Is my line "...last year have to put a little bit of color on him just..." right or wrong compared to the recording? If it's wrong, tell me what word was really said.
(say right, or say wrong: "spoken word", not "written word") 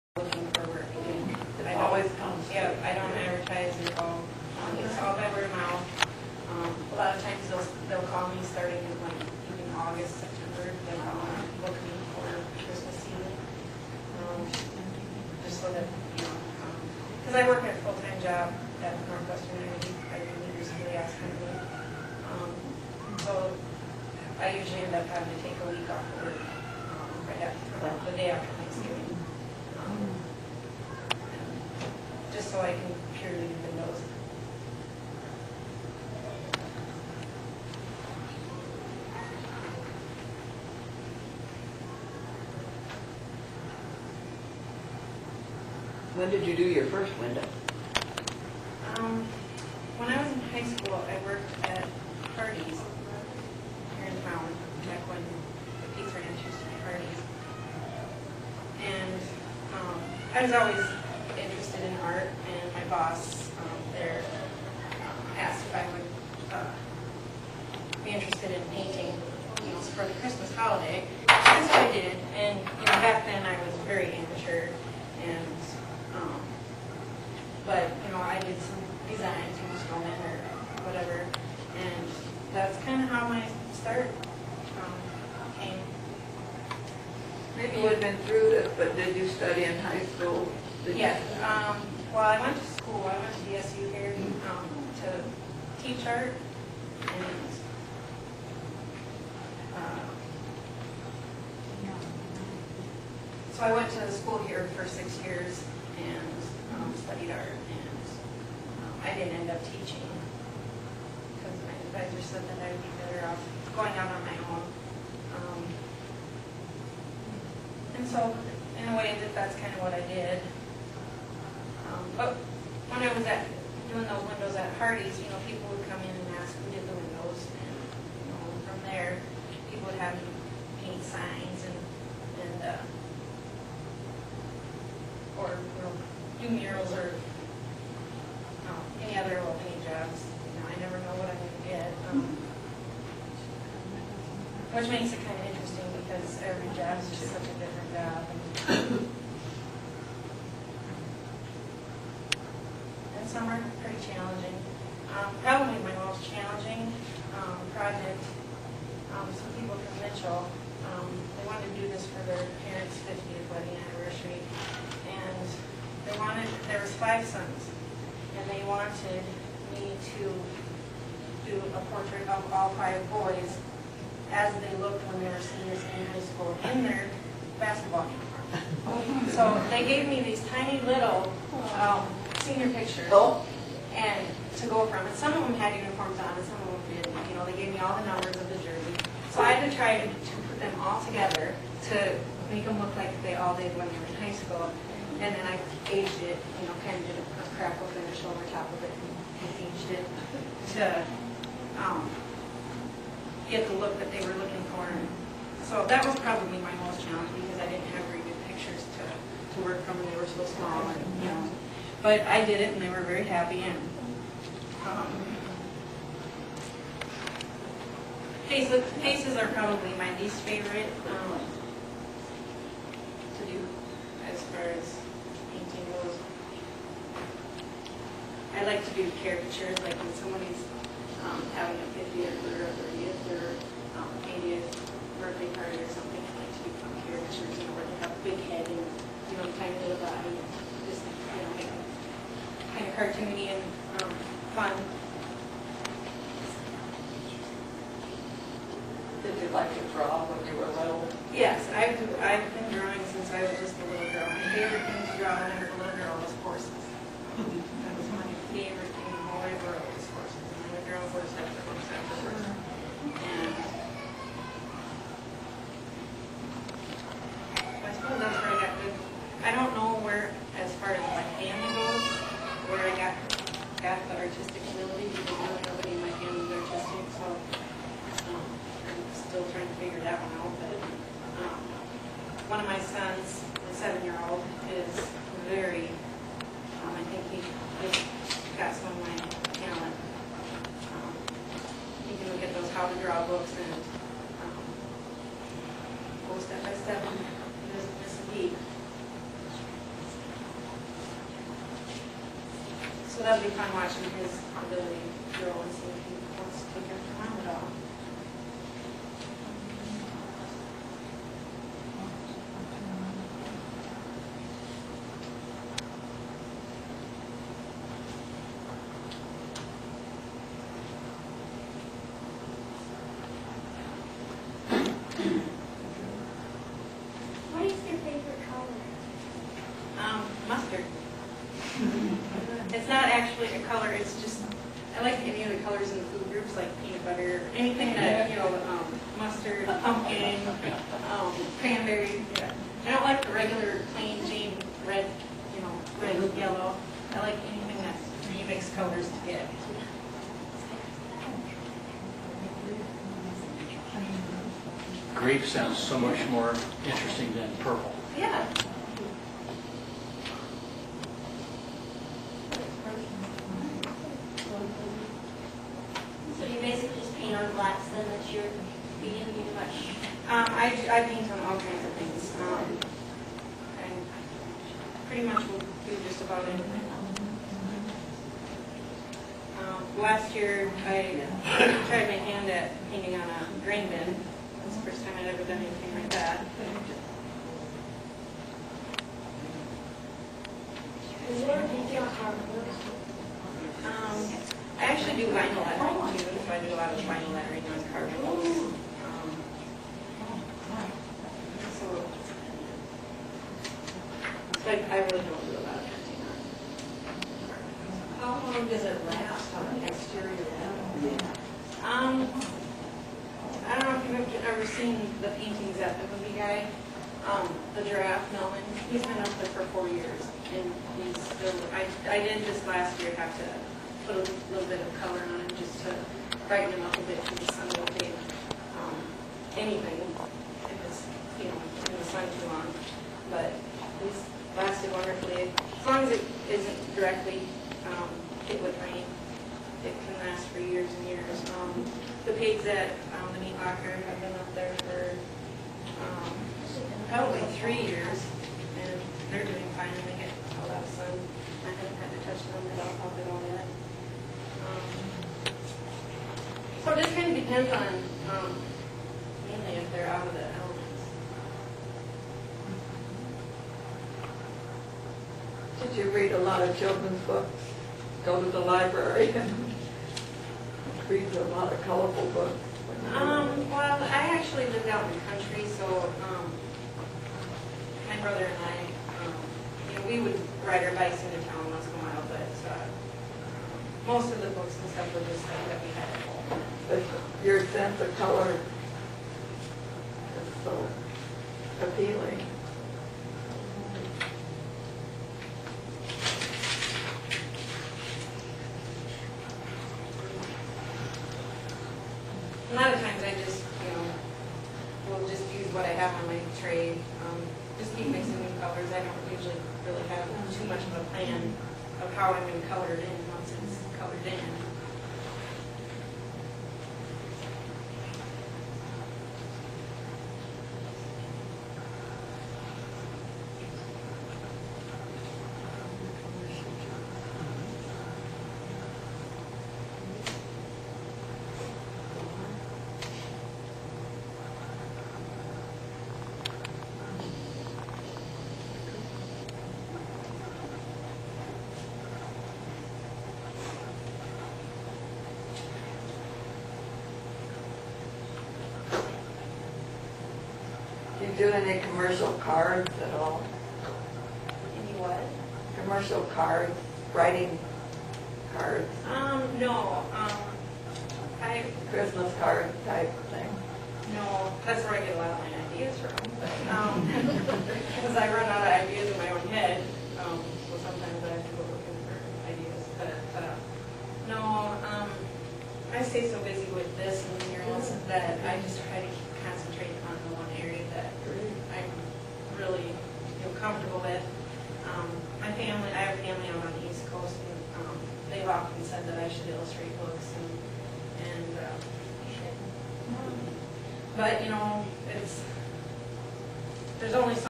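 right.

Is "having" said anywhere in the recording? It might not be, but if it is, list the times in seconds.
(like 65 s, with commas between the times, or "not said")
25 s, 231 s.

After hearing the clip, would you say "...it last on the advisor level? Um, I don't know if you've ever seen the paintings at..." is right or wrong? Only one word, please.
wrong.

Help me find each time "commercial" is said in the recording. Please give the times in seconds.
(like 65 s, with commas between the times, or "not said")
551 s, 555 s.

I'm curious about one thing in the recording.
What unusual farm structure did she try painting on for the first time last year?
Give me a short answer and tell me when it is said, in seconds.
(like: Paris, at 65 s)
grain bin, at 383 s.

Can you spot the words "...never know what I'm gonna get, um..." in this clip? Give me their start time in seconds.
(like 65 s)
140 s.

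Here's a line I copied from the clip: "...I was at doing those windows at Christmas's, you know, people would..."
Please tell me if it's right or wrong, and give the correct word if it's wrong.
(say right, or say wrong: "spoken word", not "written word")
wrong: "Hardy", not "Christmas".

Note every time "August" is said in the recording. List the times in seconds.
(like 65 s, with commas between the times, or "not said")
9 s.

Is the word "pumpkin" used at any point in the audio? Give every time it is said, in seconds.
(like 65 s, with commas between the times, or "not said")
339 s.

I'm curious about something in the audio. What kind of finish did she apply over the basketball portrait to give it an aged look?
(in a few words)
crackle finish.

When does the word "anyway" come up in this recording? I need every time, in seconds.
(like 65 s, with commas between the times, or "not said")
429 s.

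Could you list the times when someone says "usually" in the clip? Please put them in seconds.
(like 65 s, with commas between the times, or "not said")
24 s, 509 s.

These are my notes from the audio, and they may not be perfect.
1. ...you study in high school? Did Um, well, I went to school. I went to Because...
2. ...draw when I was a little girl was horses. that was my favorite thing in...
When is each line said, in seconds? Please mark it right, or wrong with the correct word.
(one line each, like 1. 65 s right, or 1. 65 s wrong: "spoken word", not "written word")
1. 89 s wrong: "DSU", not "Because"
2. 255 s right.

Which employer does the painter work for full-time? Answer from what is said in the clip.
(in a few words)
Northwestern Energy.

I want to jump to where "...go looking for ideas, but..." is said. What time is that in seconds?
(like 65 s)
571 s.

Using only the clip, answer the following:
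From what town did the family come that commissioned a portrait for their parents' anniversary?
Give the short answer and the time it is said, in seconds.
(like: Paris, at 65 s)
Mitchell, at 160 s.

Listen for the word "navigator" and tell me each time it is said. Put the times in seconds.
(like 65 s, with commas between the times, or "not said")
not said.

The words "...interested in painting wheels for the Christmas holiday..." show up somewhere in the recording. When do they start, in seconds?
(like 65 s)
68 s.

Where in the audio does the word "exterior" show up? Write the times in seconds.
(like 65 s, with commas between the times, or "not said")
409 s.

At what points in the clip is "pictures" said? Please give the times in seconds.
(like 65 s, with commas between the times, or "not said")
182 s, 208 s.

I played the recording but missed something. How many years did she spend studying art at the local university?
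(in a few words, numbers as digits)
6.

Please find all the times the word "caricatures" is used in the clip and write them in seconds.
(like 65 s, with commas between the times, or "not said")
229 s, 237 s.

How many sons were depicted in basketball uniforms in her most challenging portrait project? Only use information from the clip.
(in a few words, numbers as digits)
5.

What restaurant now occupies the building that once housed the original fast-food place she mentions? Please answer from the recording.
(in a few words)
Pizza Ranch.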